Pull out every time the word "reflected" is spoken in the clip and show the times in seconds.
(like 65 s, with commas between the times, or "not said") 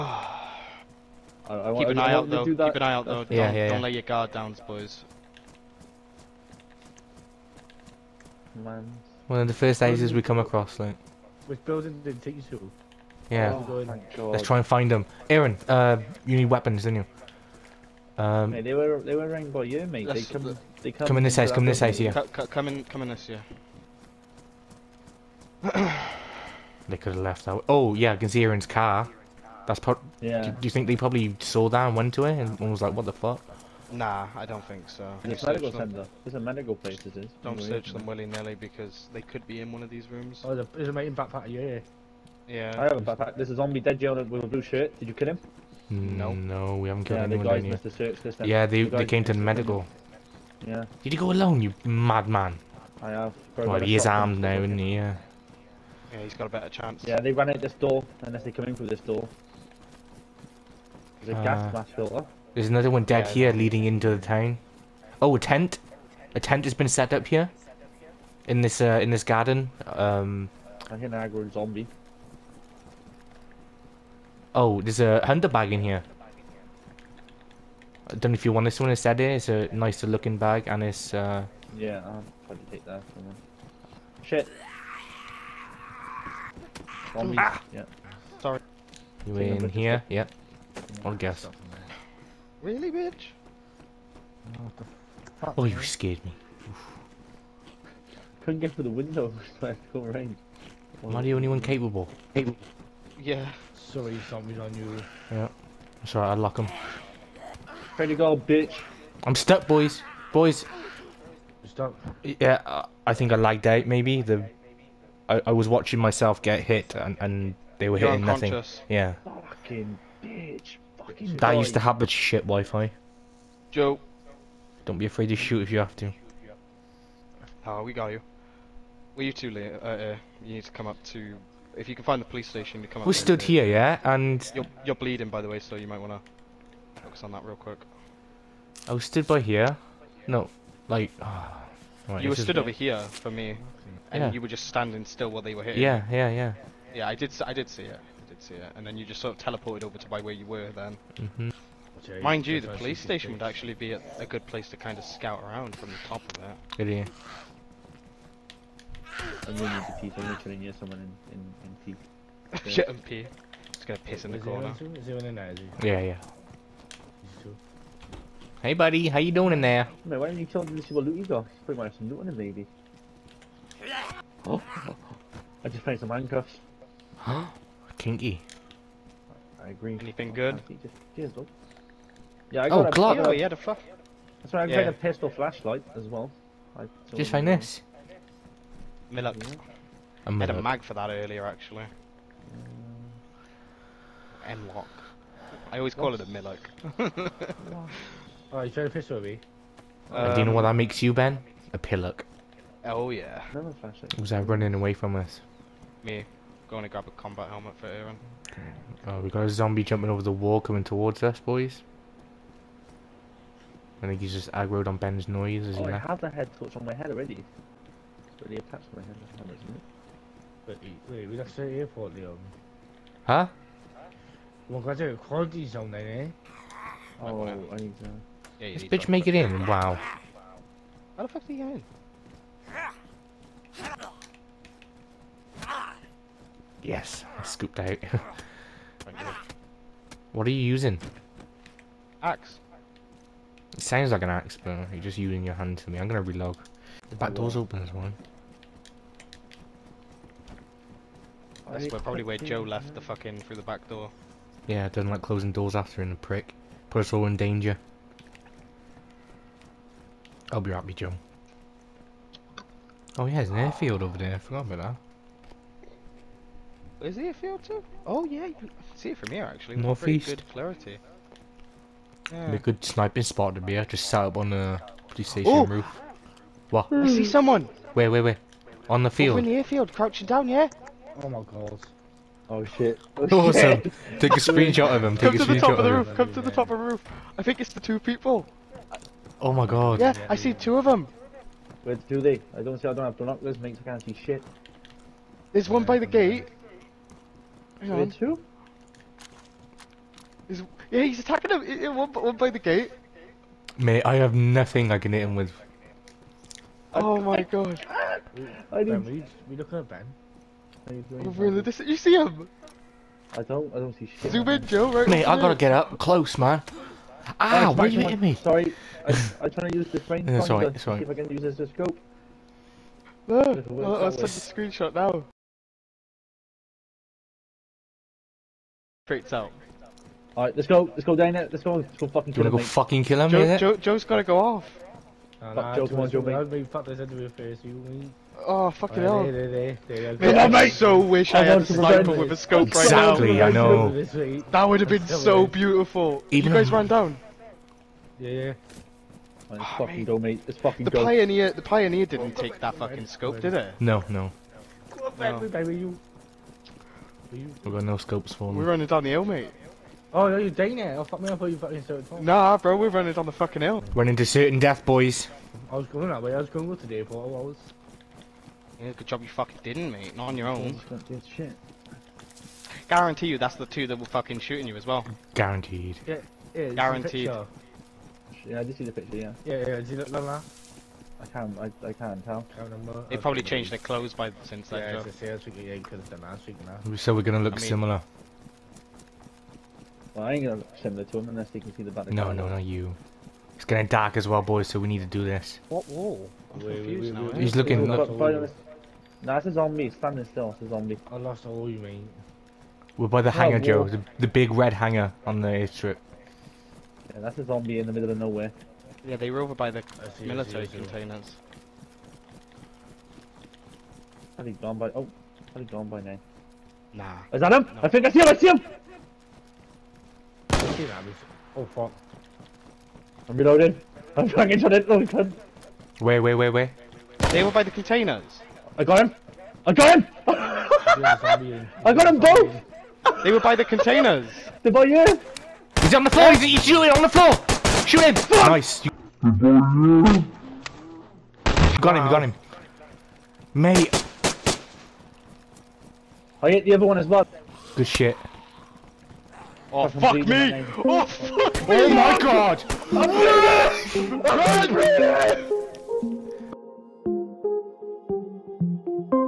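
not said.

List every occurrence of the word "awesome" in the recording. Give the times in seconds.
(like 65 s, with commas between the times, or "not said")
283 s.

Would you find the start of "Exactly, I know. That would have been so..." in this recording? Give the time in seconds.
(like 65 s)
343 s.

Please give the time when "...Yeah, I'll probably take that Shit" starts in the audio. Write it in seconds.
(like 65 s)
81 s.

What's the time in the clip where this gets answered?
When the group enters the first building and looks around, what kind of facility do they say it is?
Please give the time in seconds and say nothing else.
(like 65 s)
35 s.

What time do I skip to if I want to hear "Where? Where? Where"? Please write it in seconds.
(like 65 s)
277 s.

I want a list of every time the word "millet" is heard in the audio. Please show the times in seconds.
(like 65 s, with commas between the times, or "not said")
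189 s, 196 s.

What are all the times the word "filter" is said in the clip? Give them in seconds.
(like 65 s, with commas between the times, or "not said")
61 s.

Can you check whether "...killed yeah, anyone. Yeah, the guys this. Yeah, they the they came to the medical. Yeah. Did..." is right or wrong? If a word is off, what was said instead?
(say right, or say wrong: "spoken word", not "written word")
right.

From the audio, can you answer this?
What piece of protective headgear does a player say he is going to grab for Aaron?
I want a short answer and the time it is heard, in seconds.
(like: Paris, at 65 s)
Combat helmet, at 207 s.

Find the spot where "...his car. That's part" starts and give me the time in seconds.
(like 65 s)
28 s.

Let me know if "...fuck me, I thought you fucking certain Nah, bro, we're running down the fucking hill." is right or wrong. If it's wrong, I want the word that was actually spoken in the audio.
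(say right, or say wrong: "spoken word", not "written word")
right.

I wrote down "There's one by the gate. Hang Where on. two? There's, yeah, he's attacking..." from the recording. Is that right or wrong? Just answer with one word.
right.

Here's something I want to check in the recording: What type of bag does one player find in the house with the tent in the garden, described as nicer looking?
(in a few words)
Hunter bag.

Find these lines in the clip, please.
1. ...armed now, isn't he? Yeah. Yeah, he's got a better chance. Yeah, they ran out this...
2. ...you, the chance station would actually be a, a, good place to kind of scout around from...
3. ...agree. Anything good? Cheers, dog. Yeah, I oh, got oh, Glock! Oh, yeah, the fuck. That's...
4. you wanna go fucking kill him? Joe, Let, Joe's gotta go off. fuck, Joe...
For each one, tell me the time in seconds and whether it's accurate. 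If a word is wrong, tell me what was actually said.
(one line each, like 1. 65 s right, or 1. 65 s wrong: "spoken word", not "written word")
1. 54 s right
2. 152 s wrong: "police", not "chance"
3. 179 s right
4. 332 s wrong: "Joe", not "Let".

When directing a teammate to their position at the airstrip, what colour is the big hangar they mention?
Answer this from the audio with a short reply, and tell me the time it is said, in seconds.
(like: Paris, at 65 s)
Red, at 404 s.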